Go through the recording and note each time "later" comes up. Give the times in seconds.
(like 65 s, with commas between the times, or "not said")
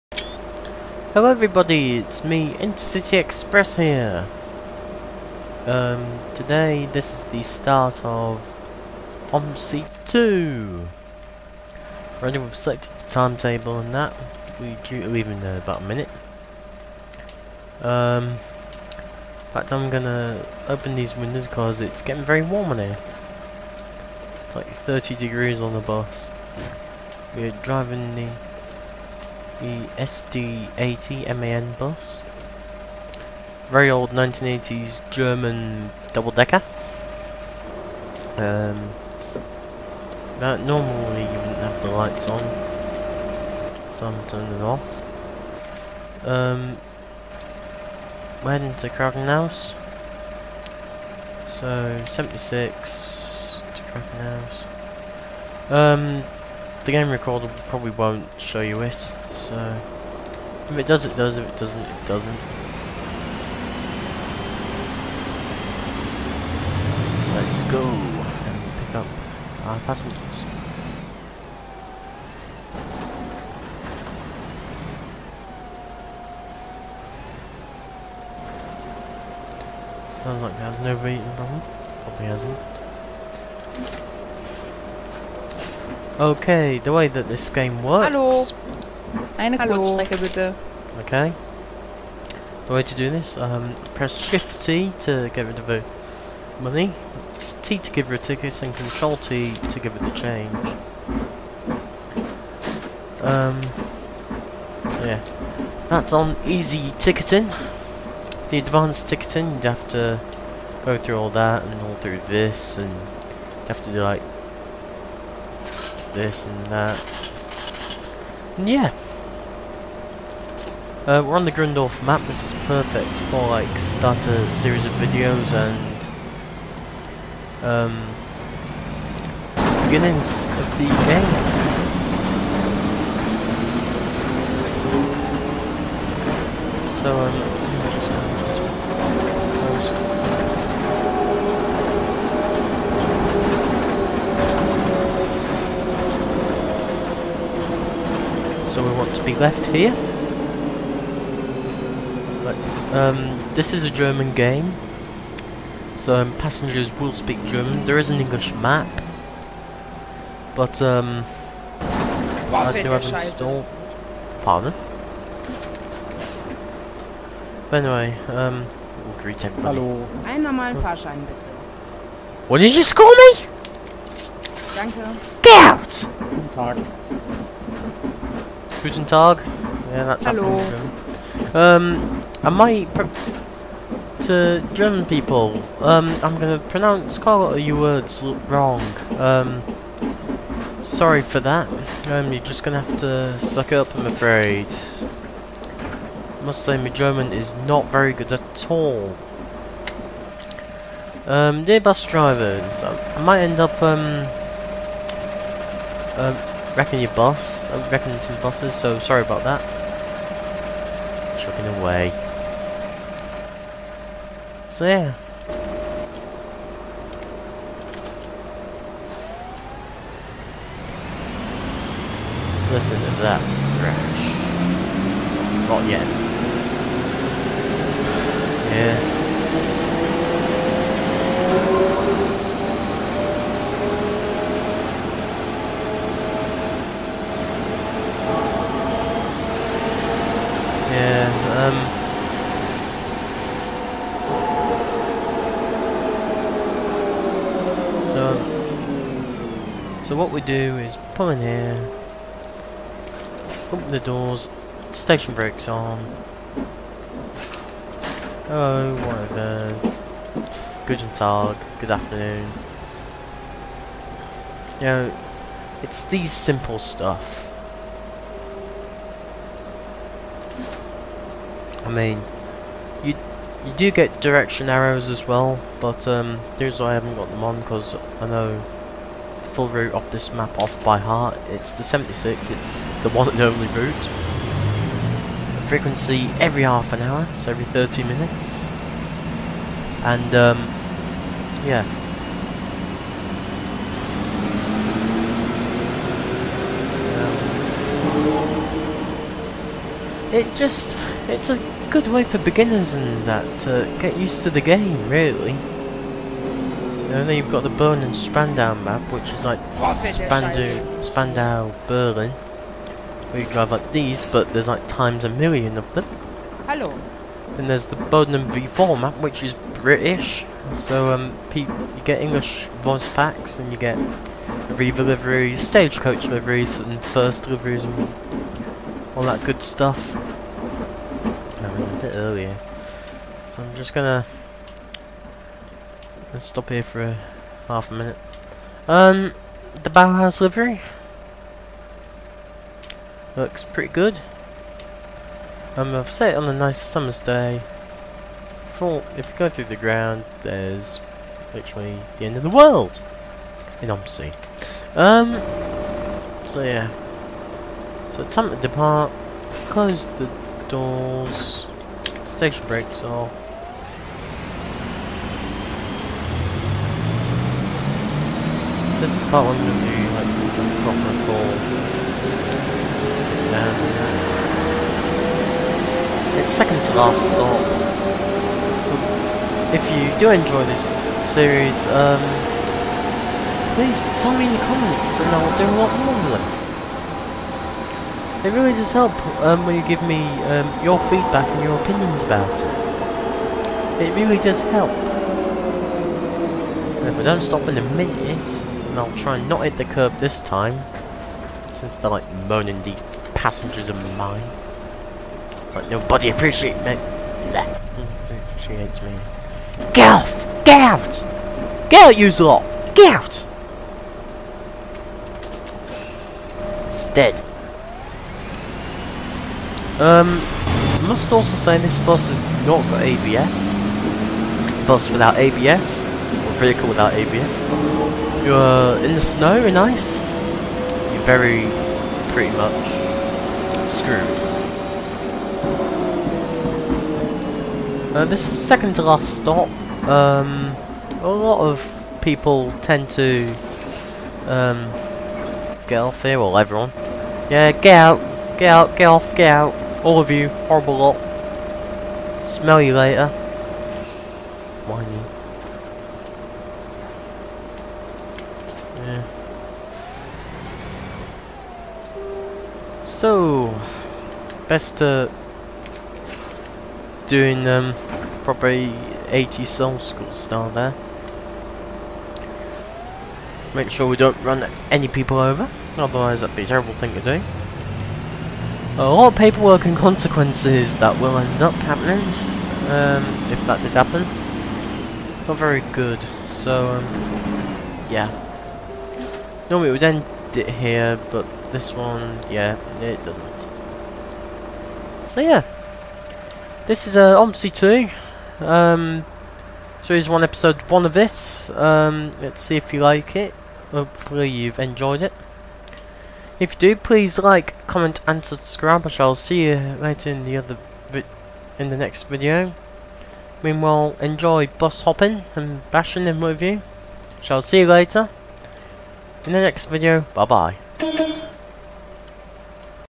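452 s, 510 s, 517 s.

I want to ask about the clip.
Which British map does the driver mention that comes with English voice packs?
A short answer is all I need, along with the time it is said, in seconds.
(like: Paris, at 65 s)
Bodenham V4, at 317 s.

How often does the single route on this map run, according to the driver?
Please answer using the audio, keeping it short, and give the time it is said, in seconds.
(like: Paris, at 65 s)
every half an hour, at 286 s.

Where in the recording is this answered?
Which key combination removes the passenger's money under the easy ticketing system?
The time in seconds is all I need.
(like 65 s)
94 s.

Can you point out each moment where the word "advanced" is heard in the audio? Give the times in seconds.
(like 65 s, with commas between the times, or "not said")
108 s.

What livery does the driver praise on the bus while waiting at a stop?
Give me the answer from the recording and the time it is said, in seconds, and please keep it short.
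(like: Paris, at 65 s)
Bauhaus, at 339 s.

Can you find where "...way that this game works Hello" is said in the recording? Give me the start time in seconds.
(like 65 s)
86 s.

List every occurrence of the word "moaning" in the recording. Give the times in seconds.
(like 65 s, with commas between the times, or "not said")
402 s.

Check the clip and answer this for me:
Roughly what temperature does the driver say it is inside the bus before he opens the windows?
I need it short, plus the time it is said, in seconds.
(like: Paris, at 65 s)
30 degrees, at 24 s.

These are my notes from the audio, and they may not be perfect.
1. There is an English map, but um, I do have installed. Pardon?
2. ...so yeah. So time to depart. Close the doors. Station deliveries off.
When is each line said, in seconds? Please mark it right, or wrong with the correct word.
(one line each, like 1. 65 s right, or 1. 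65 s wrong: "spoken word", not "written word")
1. 157 s right
2. 356 s wrong: "brakes", not "deliveries".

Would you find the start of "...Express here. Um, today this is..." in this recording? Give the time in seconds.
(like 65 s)
3 s.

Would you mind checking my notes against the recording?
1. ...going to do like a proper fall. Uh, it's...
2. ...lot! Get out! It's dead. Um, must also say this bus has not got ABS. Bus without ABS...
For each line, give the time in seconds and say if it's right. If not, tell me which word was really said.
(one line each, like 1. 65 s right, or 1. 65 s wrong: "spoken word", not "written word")
1. 369 s right
2. 412 s right.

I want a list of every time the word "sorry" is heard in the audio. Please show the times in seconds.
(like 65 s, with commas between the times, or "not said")
190 s, 208 s.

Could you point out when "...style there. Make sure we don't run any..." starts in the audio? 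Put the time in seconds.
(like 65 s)
470 s.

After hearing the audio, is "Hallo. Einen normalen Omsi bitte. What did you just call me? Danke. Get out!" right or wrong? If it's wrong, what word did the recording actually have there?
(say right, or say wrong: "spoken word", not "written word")
wrong: "Fahrschein", not "Omsi".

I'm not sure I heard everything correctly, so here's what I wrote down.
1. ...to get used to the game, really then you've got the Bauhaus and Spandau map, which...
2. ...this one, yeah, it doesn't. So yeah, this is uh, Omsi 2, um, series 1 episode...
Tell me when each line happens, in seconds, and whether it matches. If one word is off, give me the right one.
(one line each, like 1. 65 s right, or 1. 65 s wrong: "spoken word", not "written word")
1. 303 s wrong: "Berlin", not "Bauhaus"
2. 491 s right.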